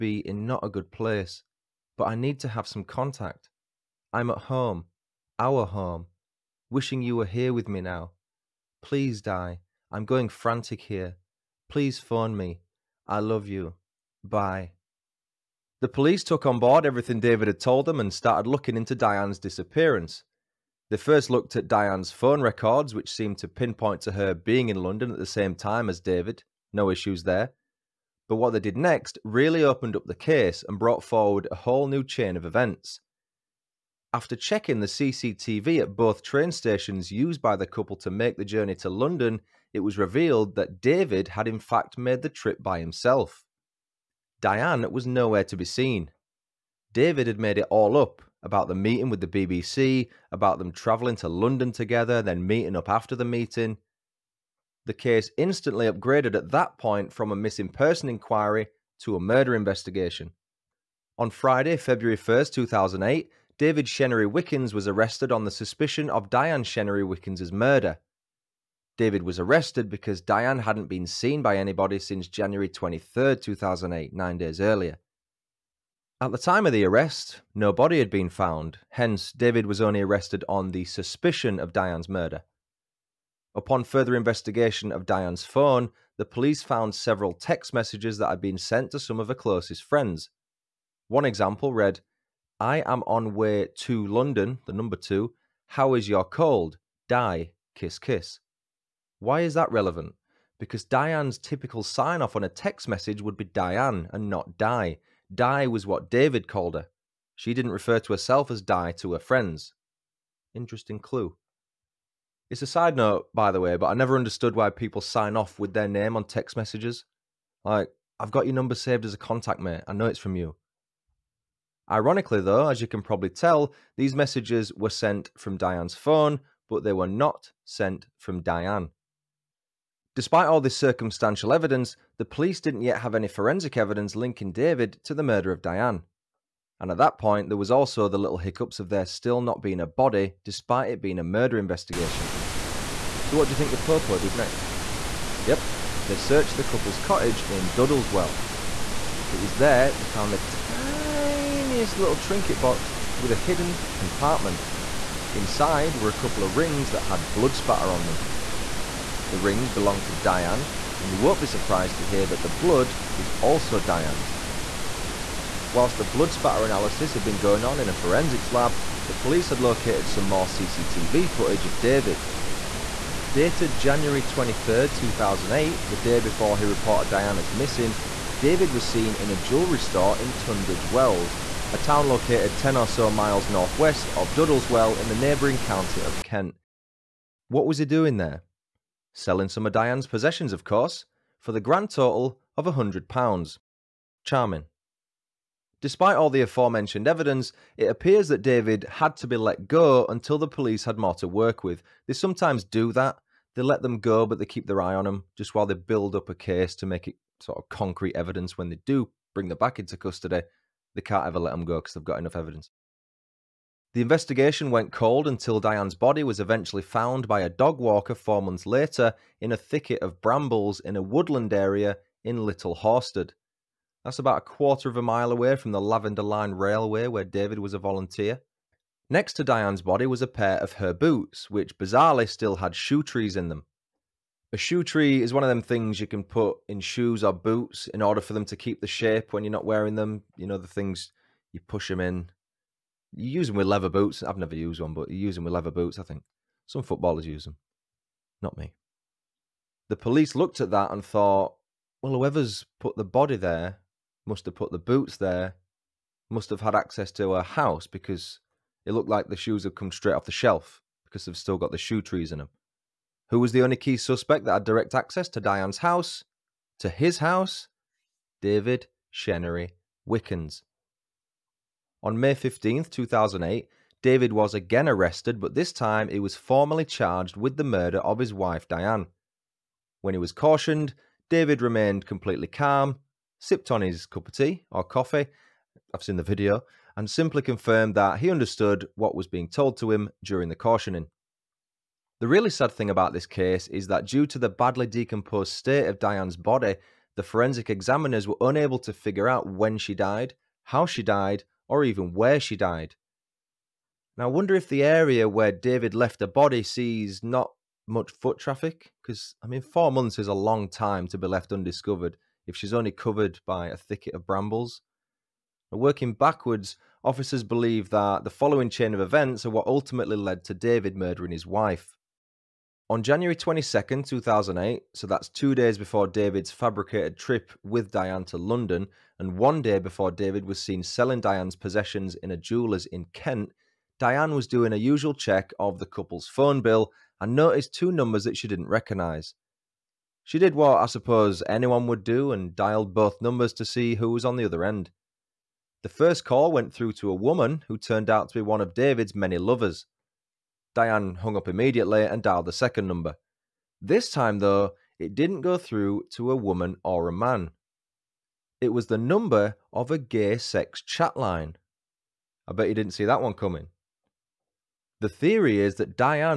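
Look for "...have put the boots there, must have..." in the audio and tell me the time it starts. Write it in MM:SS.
04:14.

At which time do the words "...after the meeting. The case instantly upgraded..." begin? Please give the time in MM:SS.
00:52.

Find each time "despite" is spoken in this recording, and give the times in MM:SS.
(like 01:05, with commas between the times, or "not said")
02:10, 02:20, 03:15.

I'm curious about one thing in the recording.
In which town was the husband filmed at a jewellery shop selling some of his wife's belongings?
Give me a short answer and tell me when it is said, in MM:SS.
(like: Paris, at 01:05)
Tunbridge Wells, at 03:00.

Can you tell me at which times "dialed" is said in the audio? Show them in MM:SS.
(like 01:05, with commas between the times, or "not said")
05:42, 05:52.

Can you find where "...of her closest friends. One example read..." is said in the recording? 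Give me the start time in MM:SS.
01:29.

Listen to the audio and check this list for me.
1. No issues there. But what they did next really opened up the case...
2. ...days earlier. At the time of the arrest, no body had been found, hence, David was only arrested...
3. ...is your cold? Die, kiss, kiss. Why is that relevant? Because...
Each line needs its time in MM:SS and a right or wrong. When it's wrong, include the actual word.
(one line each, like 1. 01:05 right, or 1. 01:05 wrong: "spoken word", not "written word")
1. 00:26 right
2. 01:14 right
3. 01:35 right.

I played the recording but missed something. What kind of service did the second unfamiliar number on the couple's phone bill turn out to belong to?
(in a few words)
Gay sex chat line.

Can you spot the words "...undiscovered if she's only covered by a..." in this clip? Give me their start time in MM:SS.
05:11.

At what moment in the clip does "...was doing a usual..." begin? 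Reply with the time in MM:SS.
05:34.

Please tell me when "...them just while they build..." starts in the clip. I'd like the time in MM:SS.
03:25.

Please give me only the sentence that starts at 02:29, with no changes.
It was there they found the tiny tiniest little trinket box with a hidden compartment.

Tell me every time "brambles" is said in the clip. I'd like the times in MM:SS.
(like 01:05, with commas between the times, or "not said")
03:40, 05:14.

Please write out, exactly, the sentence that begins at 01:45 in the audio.
Die was what David called her.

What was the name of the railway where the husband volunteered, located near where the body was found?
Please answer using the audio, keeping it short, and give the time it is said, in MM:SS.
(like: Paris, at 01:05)
Lavender Line, at 03:45.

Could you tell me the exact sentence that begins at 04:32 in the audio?
On May 15, 2008, David was again arrested, but this time he was formally charged with the murder of his wife Diane.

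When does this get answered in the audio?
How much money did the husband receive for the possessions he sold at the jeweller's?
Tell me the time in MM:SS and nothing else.
03:12.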